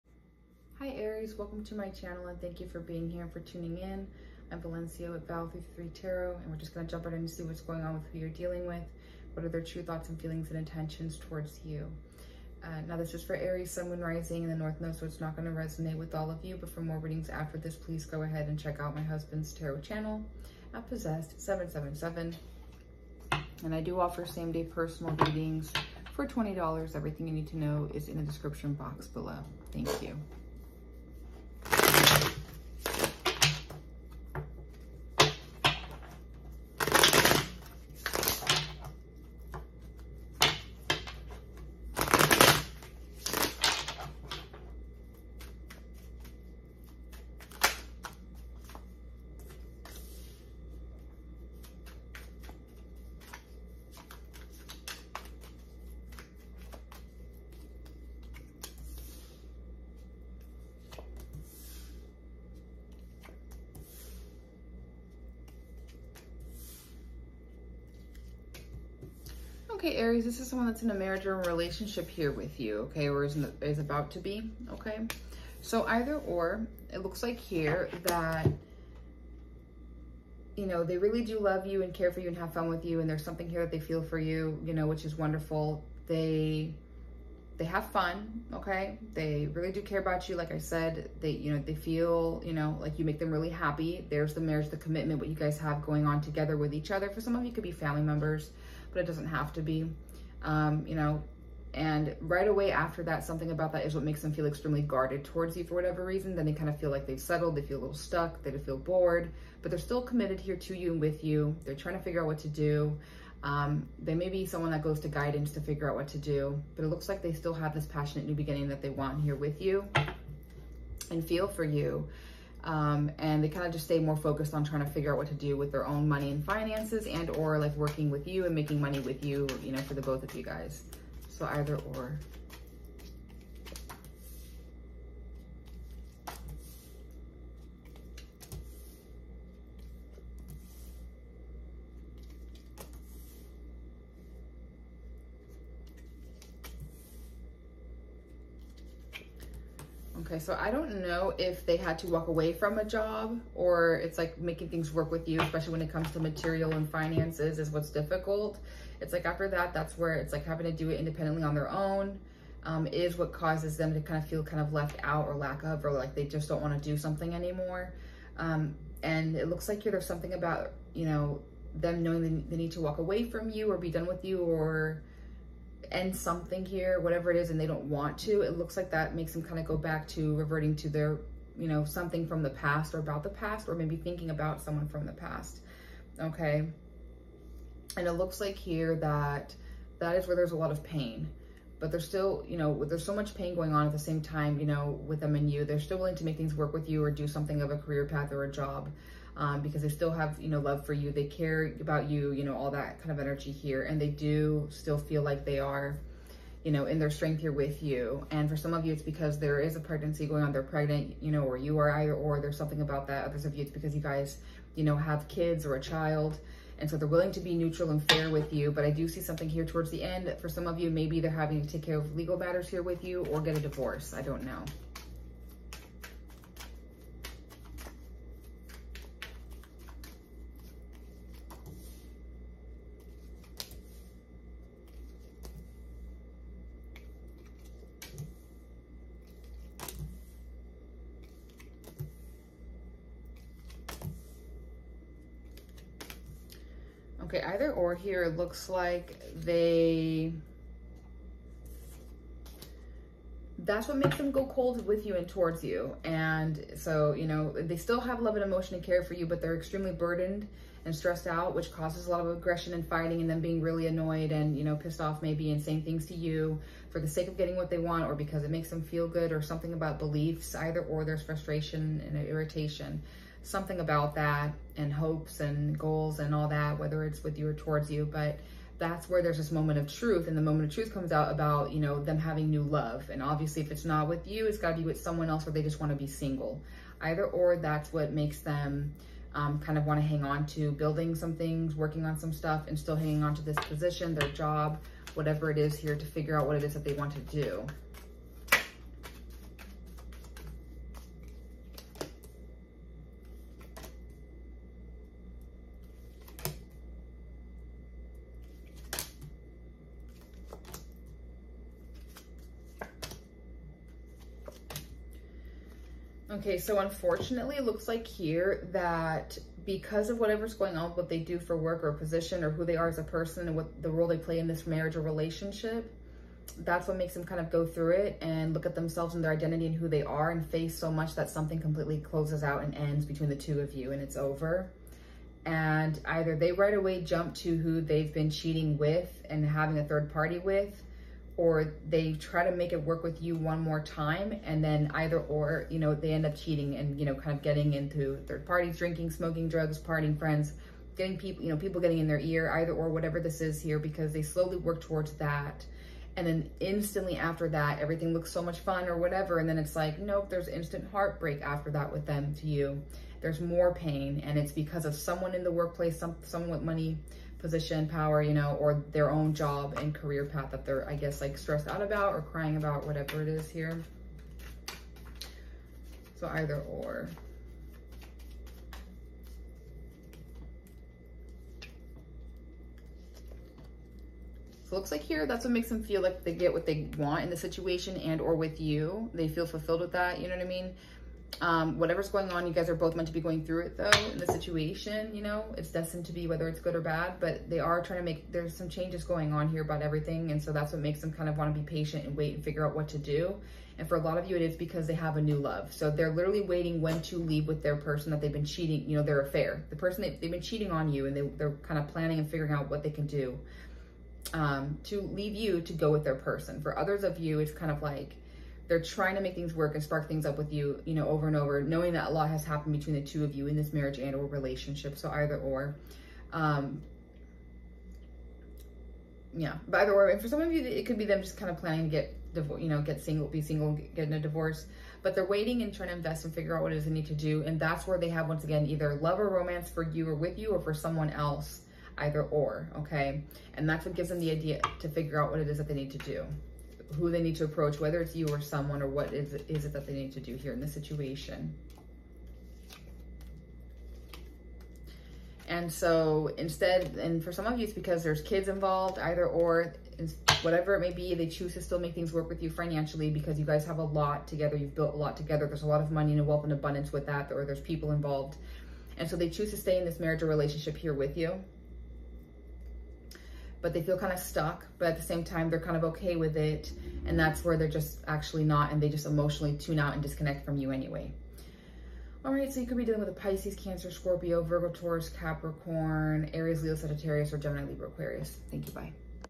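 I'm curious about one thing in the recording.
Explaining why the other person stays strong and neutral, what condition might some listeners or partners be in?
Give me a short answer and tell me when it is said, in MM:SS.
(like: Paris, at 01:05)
Pregnant, at 03:30.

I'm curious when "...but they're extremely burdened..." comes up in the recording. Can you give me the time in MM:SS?
04:19.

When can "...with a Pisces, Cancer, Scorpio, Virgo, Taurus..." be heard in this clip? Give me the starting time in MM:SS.
08:02.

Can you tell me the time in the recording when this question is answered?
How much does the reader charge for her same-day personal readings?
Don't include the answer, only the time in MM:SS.
00:26.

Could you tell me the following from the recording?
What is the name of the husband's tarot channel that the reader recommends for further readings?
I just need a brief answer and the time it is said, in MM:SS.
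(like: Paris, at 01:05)
Possessed777, at 00:20.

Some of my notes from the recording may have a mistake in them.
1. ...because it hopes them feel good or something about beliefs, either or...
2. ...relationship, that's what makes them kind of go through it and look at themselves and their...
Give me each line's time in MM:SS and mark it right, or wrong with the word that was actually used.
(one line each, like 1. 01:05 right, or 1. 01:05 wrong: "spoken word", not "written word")
1. 04:28 wrong: "makes", not "hopes"
2. 05:25 right.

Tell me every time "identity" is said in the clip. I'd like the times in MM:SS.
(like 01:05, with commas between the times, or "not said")
05:29.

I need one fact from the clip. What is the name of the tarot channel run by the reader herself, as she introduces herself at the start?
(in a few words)
Val333 Tarot.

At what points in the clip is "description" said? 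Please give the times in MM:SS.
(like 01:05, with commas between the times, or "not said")
00:28.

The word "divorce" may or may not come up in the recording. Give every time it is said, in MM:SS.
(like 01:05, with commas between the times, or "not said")
03:43, 07:14.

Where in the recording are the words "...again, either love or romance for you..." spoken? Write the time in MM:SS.
07:18.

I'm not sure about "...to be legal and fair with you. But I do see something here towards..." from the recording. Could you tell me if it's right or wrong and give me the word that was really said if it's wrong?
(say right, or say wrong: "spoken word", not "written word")
wrong: "neutral", not "legal".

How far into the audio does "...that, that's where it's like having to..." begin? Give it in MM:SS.
02:39.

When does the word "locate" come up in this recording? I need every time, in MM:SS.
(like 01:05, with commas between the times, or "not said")
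not said.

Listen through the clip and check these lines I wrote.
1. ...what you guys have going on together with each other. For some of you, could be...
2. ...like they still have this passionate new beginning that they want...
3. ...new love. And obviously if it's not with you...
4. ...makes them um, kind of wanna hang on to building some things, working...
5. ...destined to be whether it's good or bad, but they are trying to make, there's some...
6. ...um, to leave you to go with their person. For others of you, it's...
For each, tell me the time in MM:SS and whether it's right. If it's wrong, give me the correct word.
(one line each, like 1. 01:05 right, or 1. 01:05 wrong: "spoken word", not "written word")
1. 01:35 right
2. 01:57 right
3. 04:42 right
4. 04:48 right
5. 06:35 right
6. 06:54 right.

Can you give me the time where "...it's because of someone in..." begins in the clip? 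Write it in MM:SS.
06:04.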